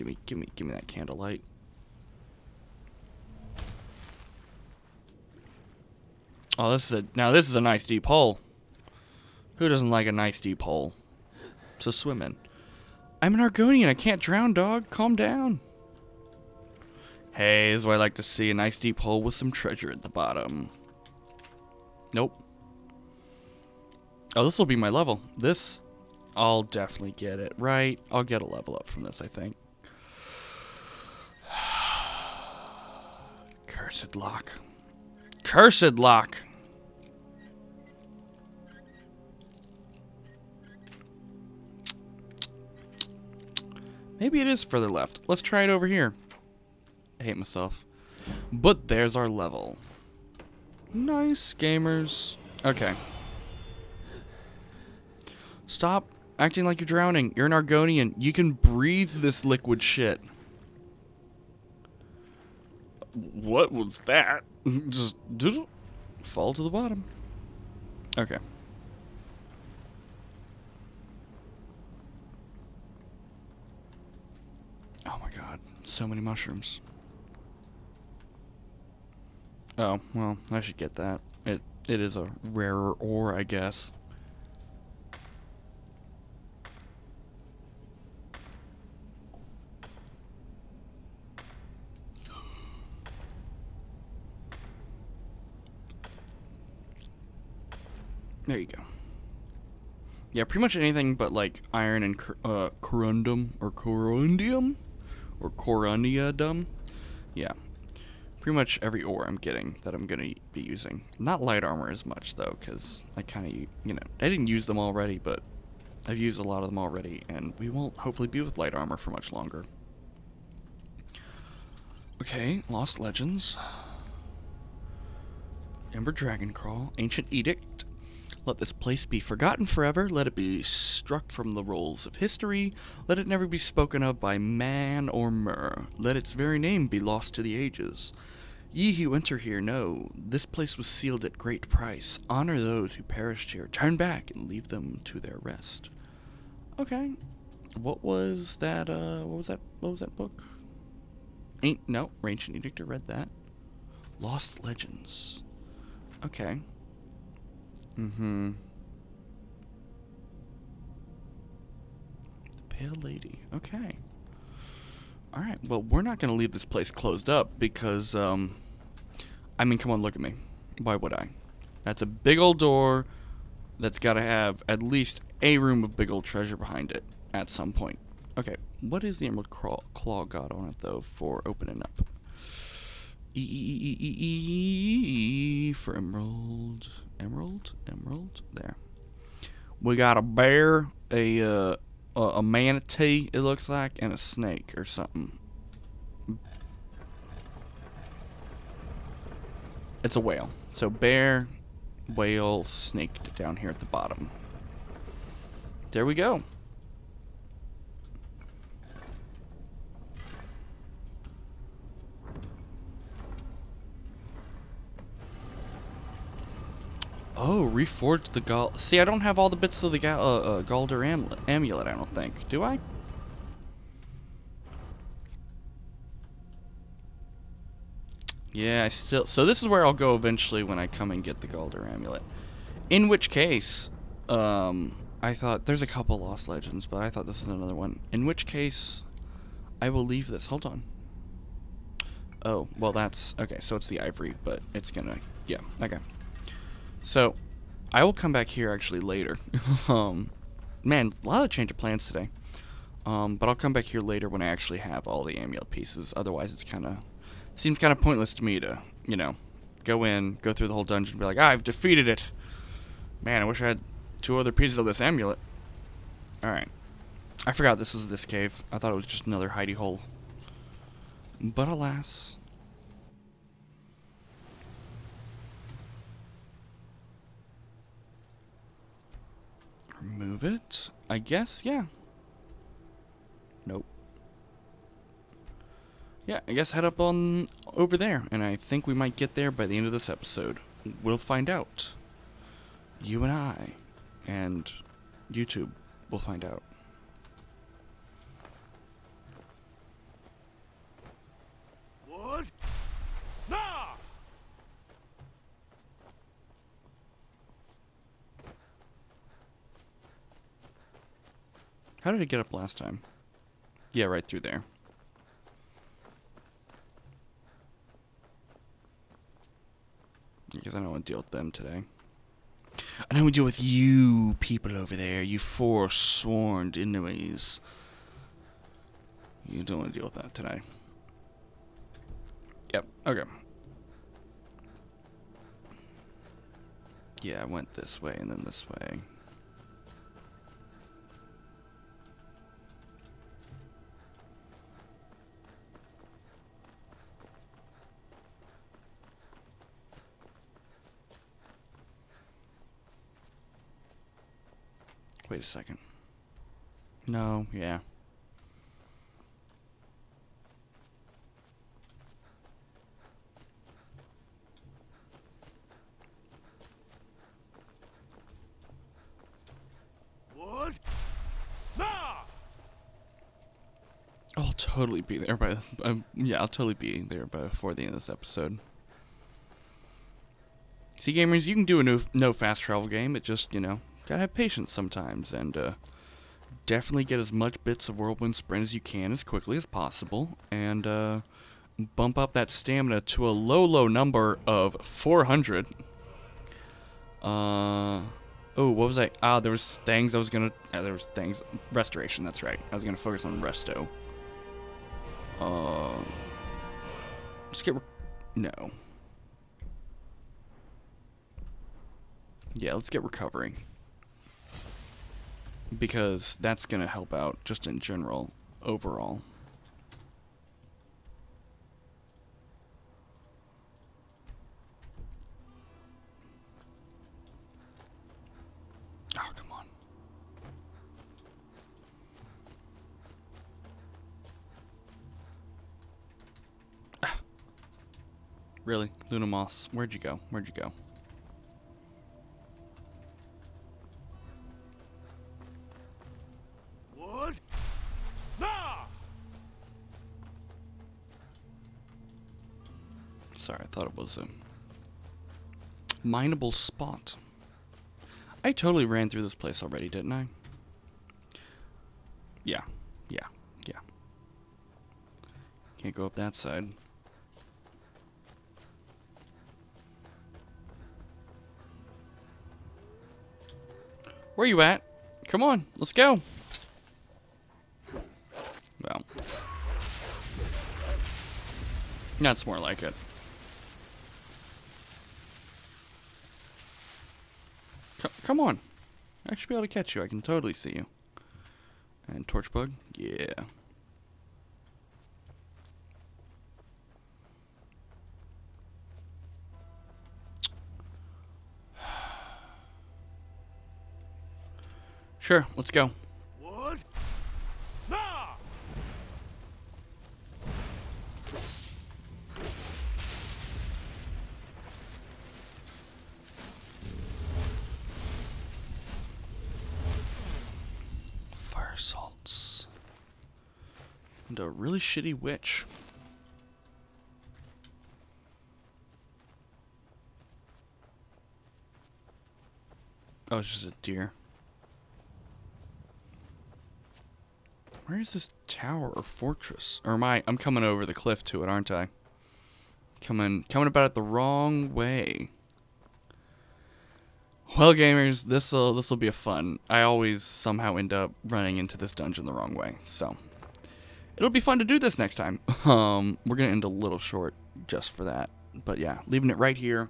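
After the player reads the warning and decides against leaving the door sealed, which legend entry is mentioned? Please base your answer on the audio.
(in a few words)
The Pale Lady.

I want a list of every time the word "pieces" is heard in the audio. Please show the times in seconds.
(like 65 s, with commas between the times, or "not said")
255 s, 264 s.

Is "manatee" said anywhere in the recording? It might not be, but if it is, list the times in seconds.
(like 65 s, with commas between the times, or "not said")
192 s.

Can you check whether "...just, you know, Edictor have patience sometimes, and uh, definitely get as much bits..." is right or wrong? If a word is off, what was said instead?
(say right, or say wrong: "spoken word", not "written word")
wrong: "Gotta", not "Edictor".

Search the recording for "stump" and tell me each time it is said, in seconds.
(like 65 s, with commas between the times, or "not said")
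not said.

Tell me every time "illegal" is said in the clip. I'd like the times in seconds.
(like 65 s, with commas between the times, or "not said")
not said.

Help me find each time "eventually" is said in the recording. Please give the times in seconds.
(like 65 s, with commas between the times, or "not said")
230 s.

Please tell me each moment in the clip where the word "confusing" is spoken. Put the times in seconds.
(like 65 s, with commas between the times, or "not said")
not said.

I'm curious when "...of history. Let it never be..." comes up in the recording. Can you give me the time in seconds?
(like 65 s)
132 s.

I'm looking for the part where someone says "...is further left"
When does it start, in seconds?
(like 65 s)
44 s.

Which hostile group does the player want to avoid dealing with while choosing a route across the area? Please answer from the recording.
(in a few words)
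Forsworn.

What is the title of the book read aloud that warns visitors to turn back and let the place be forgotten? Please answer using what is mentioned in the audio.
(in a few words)
Ancient Edict.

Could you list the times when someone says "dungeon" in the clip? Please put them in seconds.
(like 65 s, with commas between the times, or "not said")
260 s, 551 s.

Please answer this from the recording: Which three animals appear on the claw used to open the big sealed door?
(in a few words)
Bear, whale, snake.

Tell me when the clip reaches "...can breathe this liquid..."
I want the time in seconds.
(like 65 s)
58 s.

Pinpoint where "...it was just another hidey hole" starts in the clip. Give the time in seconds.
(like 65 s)
268 s.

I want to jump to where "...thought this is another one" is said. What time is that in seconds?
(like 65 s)
237 s.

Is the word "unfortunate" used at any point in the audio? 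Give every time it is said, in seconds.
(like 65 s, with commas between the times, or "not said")
not said.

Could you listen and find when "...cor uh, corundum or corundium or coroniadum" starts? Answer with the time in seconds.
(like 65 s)
102 s.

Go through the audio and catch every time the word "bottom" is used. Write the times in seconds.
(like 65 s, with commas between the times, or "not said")
20 s, 66 s, 203 s.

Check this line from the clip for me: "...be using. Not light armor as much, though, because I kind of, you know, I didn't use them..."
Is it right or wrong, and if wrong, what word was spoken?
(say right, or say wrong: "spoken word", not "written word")
right.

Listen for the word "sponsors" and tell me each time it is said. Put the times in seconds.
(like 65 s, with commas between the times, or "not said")
not said.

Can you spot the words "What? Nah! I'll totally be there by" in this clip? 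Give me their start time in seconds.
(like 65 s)
370 s.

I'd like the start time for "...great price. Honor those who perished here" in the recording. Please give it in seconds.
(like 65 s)
141 s.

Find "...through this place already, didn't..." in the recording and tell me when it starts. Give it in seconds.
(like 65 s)
459 s.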